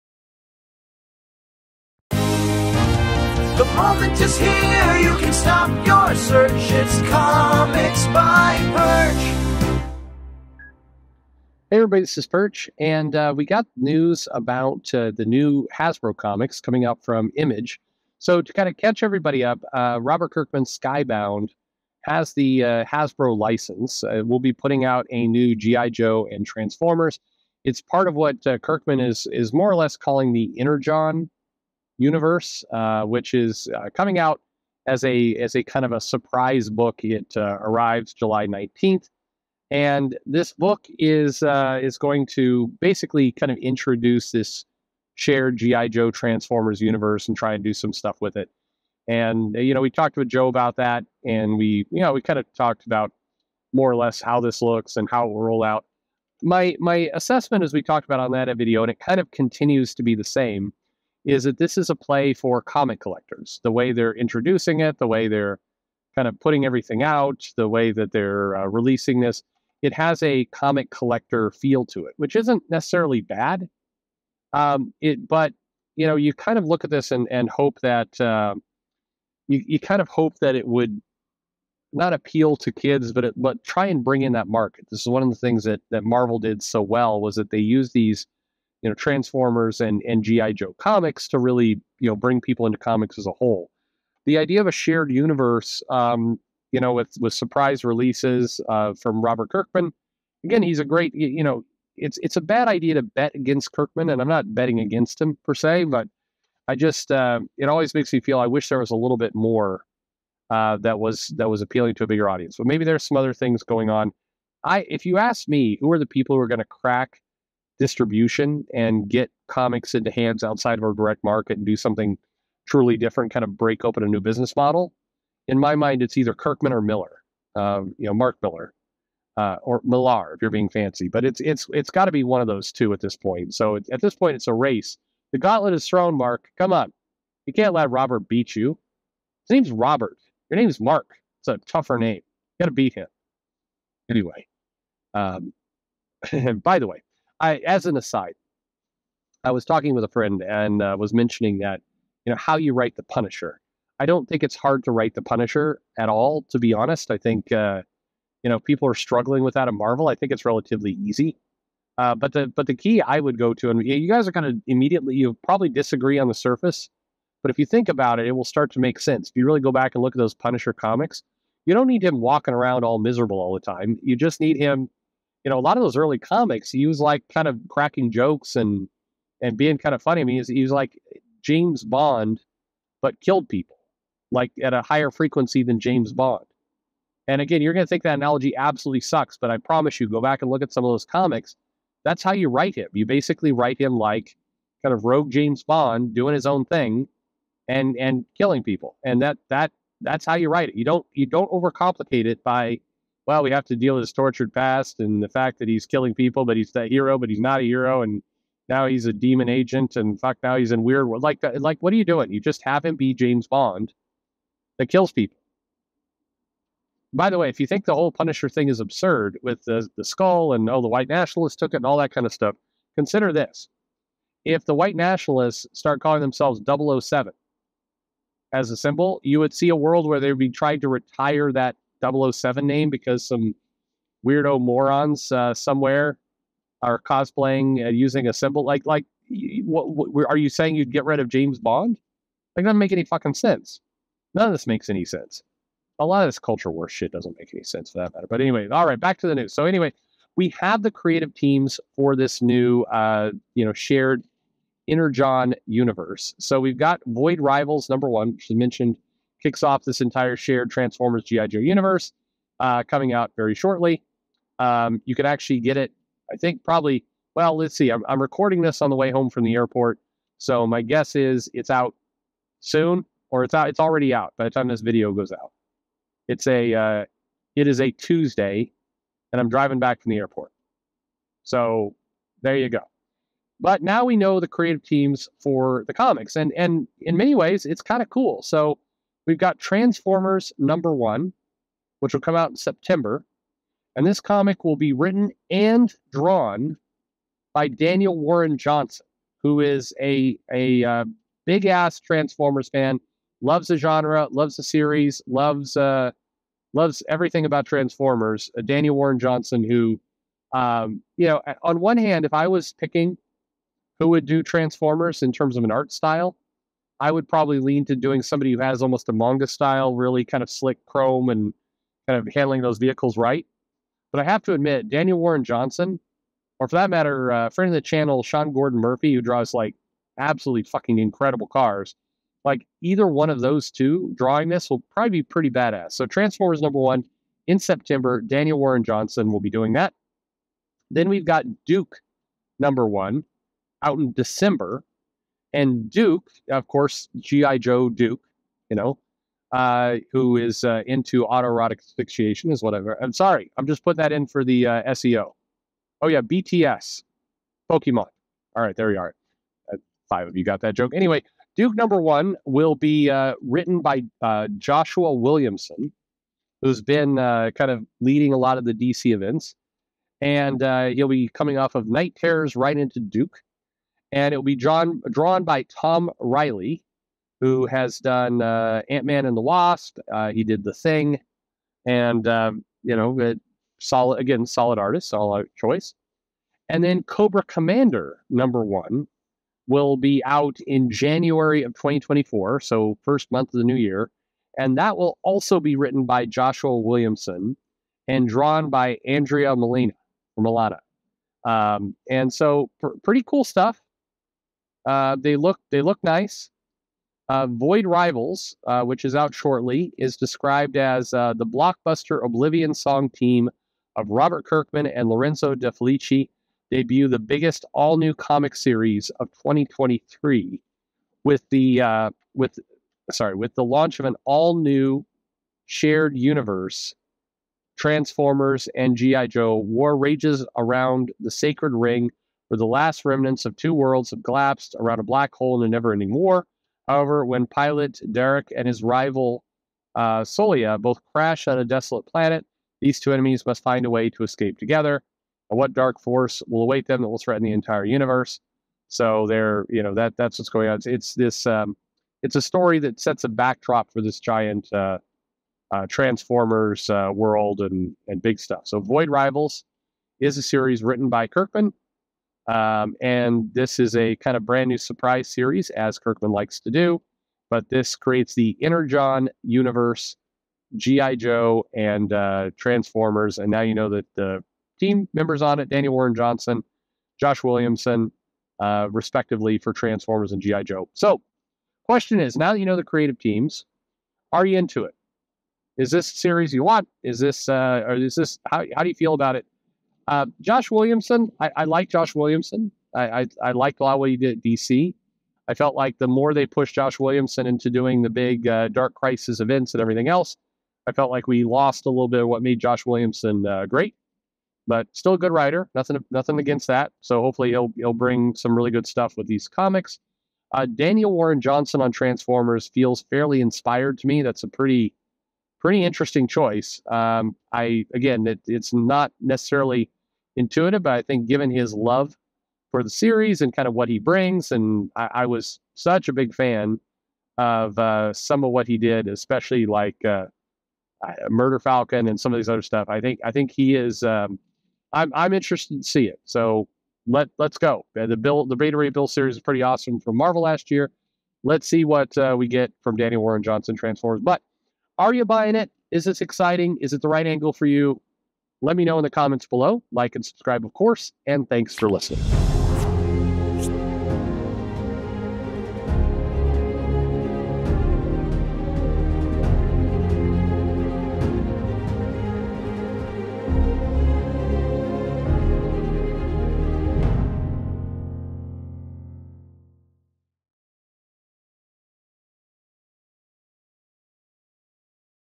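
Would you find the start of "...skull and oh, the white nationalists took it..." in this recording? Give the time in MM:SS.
03:40.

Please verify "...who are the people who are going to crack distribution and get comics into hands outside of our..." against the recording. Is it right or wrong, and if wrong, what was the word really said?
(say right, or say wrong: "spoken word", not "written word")
right.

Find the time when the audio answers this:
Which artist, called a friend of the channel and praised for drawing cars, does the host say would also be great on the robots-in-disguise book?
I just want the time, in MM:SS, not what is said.
05:28.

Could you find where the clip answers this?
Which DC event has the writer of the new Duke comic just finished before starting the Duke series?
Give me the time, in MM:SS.
06:11.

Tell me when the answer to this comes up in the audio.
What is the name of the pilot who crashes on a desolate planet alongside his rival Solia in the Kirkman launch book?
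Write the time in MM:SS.
07:18.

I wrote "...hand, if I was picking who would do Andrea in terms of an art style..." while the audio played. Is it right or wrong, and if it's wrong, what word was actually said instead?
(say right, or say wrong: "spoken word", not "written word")
wrong: "Transformers", not "Andrea".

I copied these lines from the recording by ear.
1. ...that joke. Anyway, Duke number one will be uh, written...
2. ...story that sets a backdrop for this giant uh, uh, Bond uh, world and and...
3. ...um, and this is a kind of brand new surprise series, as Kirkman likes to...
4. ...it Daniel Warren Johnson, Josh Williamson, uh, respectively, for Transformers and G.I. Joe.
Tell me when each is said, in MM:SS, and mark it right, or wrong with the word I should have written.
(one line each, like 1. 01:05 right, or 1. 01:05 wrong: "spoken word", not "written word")
1. 06:00 right
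2. 07:32 wrong: "Transformers", not "Bond"
3. 07:42 right
4. 07:55 right.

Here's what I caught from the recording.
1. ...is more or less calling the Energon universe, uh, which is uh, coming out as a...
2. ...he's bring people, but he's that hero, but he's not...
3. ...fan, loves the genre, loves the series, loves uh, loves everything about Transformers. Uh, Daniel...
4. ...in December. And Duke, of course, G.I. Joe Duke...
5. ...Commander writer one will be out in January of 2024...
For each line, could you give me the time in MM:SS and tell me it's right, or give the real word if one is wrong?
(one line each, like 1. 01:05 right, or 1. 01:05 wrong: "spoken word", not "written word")
1. 00:29 right
2. 03:25 wrong: "killing", not "bring"
3. 05:02 right
4. 05:43 right
5. 06:27 wrong: "number", not "writer".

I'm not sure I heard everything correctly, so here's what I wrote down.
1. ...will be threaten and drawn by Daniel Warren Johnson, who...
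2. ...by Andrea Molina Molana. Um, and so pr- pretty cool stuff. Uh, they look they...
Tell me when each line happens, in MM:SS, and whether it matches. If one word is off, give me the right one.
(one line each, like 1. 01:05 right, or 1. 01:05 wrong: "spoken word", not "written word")
1. 04:54 wrong: "written", not "threaten"
2. 06:38 right.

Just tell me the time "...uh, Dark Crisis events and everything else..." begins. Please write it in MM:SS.
08:18.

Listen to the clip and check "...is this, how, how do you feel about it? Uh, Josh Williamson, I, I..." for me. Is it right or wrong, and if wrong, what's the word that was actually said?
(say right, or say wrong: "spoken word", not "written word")
right.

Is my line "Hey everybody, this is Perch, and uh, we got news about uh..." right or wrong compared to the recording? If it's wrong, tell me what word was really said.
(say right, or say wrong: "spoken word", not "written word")
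right.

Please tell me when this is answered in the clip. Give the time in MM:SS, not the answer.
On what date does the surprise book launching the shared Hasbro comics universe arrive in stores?
00:38.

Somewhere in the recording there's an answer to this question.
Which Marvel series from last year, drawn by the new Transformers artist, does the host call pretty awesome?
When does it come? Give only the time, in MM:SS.
08:58.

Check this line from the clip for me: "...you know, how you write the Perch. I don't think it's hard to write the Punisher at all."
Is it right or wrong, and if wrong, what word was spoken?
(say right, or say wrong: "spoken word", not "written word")
wrong: "Punisher", not "Perch".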